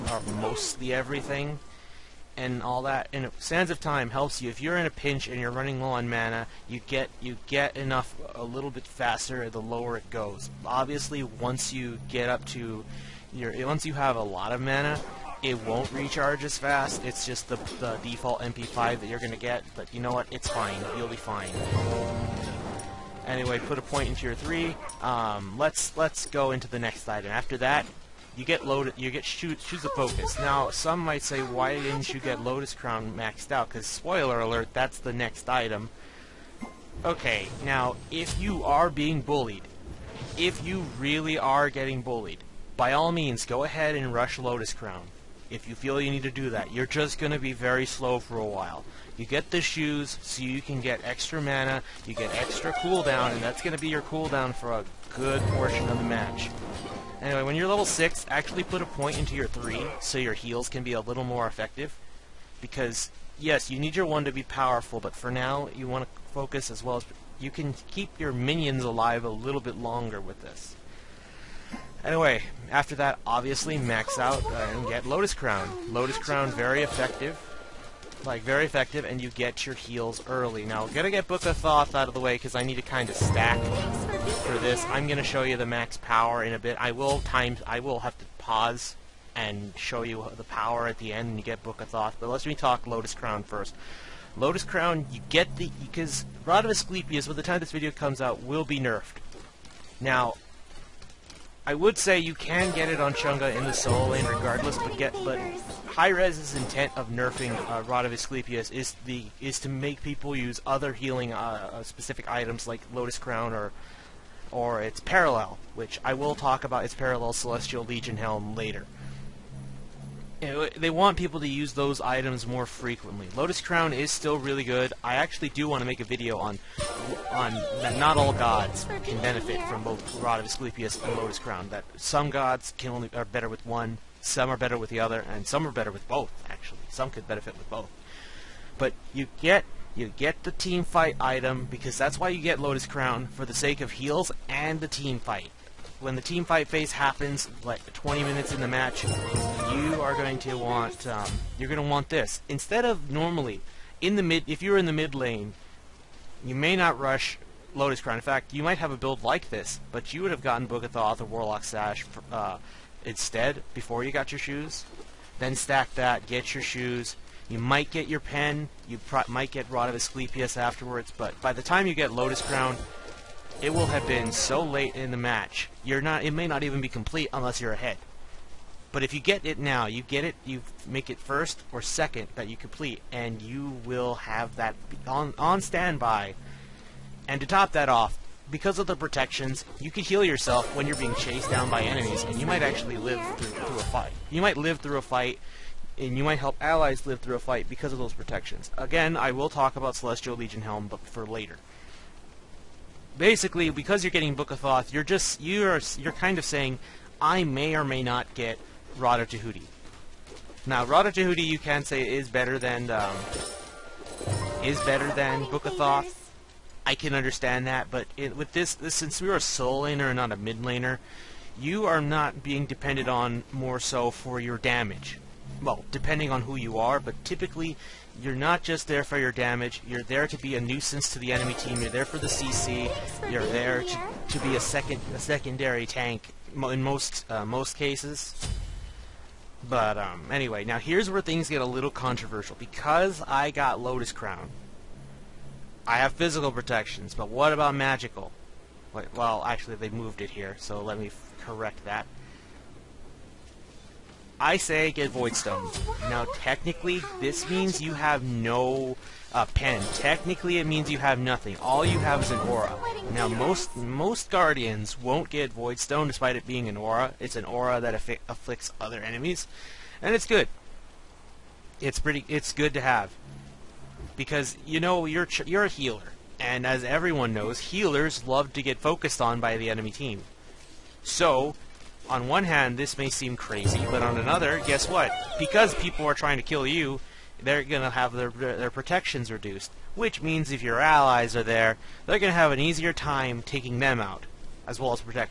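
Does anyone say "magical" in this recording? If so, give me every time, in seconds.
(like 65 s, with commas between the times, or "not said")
247 s.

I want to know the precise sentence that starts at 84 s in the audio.
I'm gonna show you the max power in a bit.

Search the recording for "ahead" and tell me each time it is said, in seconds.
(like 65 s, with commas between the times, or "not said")
43 s, 177 s.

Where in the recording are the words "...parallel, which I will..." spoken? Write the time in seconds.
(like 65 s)
114 s.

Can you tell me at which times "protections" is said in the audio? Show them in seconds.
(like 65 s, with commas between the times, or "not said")
188 s, 198 s, 246 s, 288 s.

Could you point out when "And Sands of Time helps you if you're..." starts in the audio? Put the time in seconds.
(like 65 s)
3 s.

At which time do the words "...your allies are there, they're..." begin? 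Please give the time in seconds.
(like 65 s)
290 s.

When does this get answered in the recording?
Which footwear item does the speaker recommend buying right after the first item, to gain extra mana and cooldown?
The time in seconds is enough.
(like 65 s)
29 s.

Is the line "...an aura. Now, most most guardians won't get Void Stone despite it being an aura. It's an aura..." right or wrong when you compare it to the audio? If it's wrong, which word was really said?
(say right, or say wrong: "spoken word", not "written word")
right.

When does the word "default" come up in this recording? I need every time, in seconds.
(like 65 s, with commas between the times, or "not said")
18 s.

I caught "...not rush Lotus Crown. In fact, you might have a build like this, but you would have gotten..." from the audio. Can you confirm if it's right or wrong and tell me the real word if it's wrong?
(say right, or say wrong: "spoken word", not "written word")
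right.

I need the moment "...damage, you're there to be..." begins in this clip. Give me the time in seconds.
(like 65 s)
229 s.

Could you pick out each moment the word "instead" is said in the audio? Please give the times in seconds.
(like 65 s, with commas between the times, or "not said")
152 s, 163 s.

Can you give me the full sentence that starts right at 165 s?
Then stack that, get your shoes.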